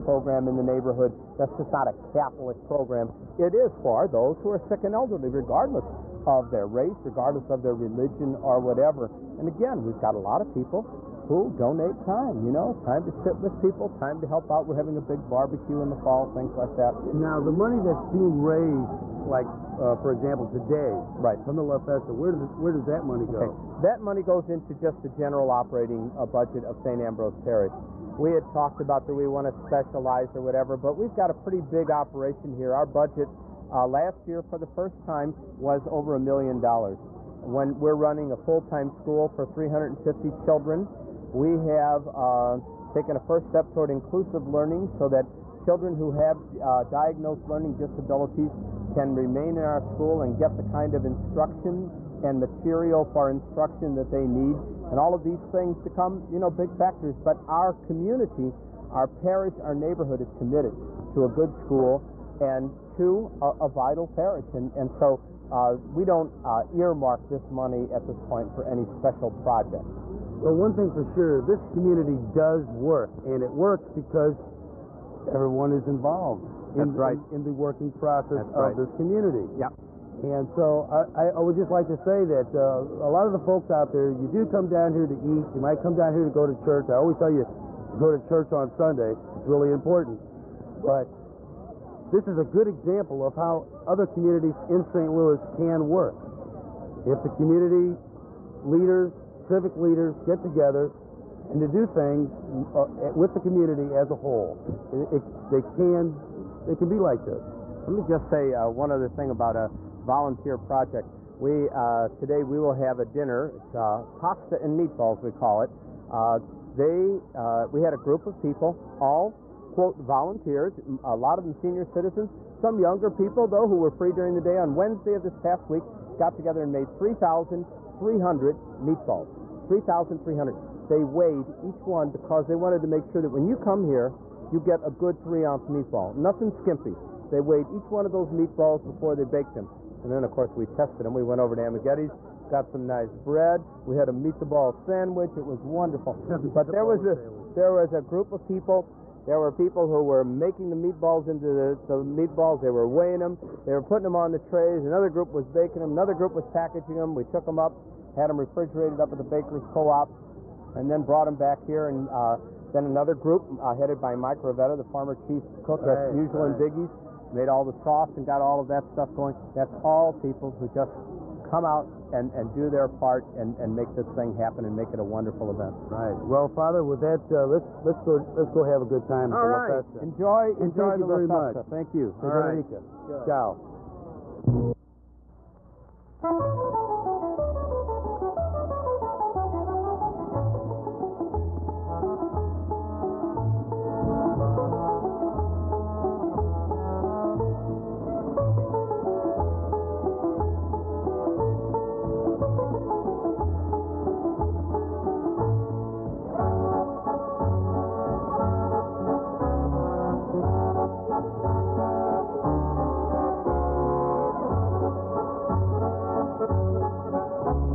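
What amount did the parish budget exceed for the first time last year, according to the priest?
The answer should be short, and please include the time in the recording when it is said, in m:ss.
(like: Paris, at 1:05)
$1,000,000, at 0:36.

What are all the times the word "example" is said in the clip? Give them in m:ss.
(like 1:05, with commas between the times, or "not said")
0:20, 1:32.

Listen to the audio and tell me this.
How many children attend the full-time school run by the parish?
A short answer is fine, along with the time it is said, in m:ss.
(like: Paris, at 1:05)
350, at 0:39.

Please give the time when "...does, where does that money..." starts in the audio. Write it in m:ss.
0:22.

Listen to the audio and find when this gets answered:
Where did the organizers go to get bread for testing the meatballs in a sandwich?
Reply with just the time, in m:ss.
2:21.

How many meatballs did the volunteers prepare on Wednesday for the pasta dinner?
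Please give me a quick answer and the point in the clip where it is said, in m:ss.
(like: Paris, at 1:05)
3,300, at 2:09.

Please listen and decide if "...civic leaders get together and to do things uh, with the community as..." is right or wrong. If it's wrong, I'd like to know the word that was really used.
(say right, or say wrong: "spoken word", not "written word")
right.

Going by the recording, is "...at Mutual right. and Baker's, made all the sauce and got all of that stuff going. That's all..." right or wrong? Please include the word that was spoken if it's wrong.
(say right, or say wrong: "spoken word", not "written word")
wrong: "Biggie", not "Baker".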